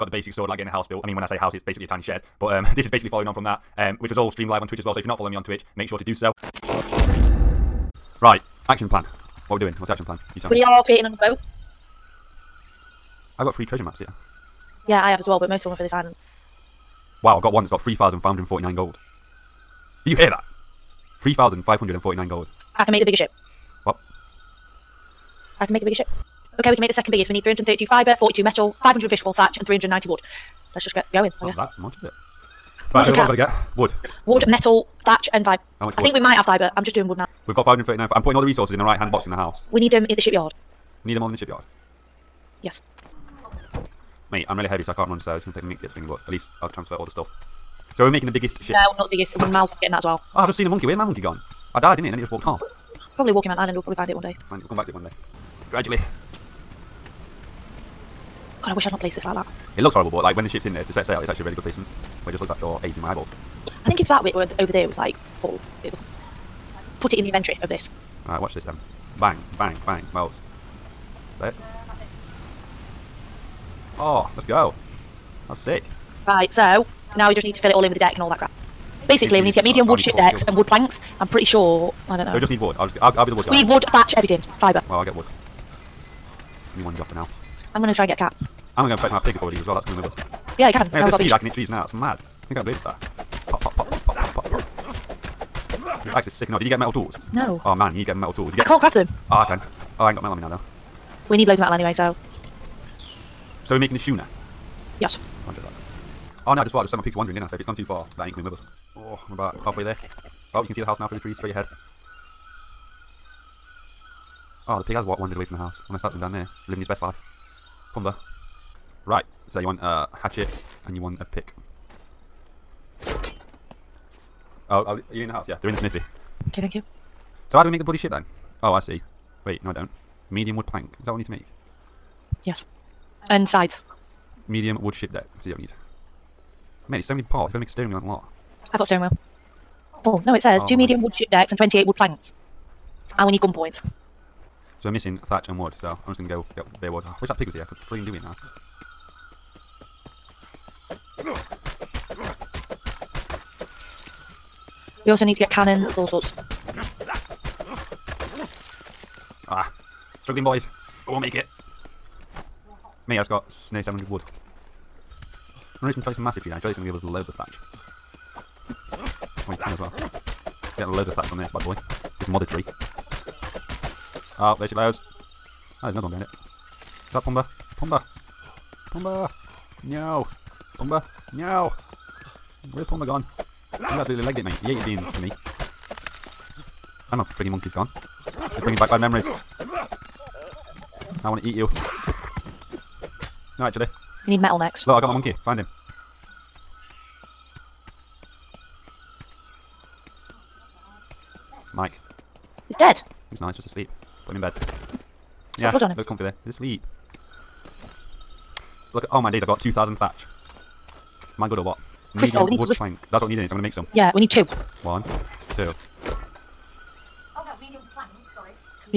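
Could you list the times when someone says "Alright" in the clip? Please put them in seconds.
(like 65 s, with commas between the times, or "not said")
68 s.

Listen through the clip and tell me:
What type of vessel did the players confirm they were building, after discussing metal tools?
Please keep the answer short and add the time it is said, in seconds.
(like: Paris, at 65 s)
schooner, at 103 s.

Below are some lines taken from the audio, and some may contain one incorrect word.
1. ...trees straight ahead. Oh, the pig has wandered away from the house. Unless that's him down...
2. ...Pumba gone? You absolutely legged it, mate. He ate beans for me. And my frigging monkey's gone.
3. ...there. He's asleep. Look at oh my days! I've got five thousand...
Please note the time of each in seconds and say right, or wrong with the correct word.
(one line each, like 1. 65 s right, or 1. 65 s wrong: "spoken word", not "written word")
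1. 111 s right
2. 182 s right
3. 206 s wrong: "two", not "five".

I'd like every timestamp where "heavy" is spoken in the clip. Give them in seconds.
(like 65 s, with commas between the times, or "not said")
44 s.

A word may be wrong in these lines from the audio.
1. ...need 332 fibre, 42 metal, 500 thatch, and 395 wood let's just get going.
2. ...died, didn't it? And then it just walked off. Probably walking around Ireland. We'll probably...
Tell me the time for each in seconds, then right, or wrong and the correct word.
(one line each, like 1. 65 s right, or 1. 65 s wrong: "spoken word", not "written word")
1. 27 s wrong: "390", not "395"
2. 51 s right.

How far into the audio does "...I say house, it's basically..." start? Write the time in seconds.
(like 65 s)
1 s.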